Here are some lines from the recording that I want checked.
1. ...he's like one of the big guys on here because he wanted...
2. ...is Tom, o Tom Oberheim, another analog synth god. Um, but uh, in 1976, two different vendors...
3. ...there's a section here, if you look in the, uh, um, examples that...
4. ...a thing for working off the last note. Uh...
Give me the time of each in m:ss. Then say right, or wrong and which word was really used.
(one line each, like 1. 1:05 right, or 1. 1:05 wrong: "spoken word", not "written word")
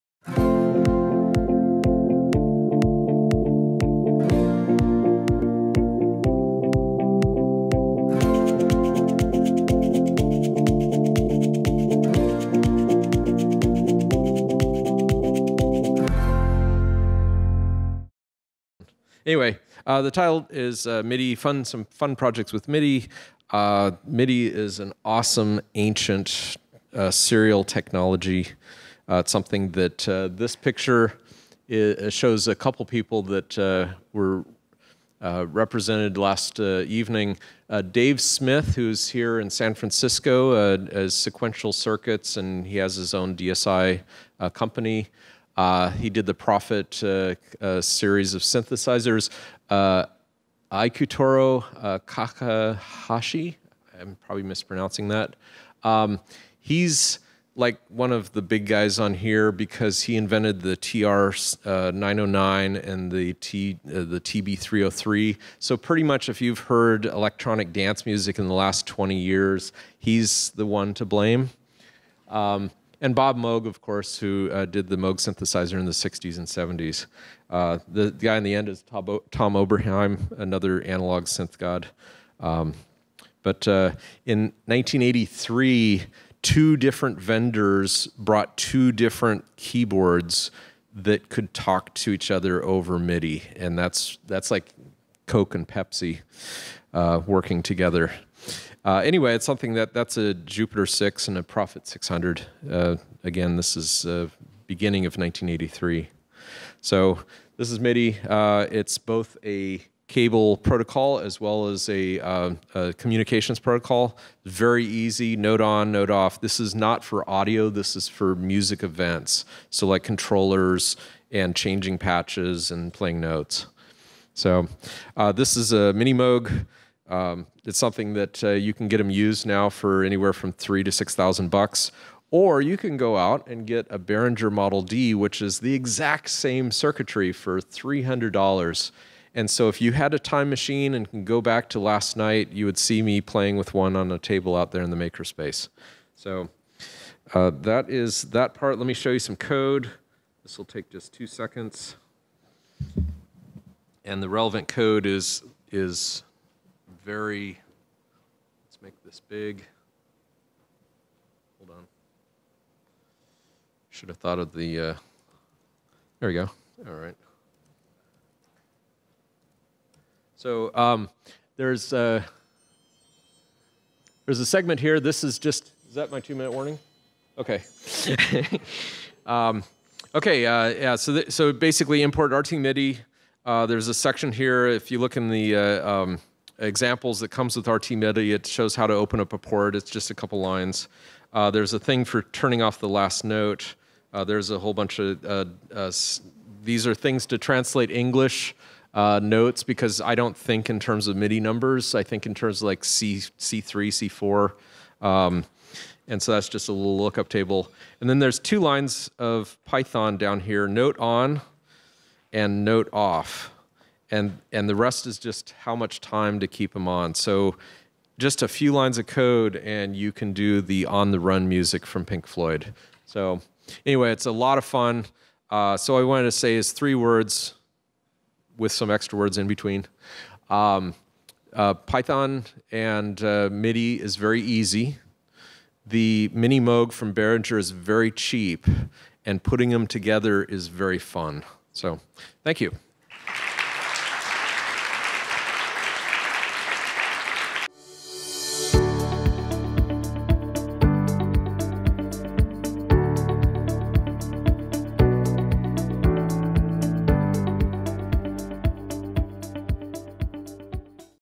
1. 0:56 wrong: "invented", not "wanted"
2. 1:18 wrong: "1983", not "1976"
3. 3:03 right
4. 3:11 wrong: "turning", not "working".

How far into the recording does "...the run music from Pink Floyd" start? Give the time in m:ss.
3:41.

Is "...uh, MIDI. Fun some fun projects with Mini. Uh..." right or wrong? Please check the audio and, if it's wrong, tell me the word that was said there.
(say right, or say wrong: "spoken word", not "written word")
wrong: "MIDI", not "Mini".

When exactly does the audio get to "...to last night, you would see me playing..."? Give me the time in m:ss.
2:21.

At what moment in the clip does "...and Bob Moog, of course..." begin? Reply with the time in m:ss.
1:13.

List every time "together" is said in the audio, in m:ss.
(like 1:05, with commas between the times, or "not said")
1:37, 3:59.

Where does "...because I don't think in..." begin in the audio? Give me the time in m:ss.
3:19.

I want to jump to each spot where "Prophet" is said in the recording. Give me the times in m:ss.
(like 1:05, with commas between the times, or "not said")
0:46, 1:41.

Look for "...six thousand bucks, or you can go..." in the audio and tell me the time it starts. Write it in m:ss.
2:10.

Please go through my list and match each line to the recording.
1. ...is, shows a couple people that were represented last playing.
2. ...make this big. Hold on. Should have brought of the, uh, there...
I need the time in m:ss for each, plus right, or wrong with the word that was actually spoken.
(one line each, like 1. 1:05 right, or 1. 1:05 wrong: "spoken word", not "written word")
1. 0:31 wrong: "evening", not "playing"
2. 2:38 wrong: "thought", not "brought".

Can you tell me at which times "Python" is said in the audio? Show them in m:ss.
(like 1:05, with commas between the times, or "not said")
3:29, 3:51.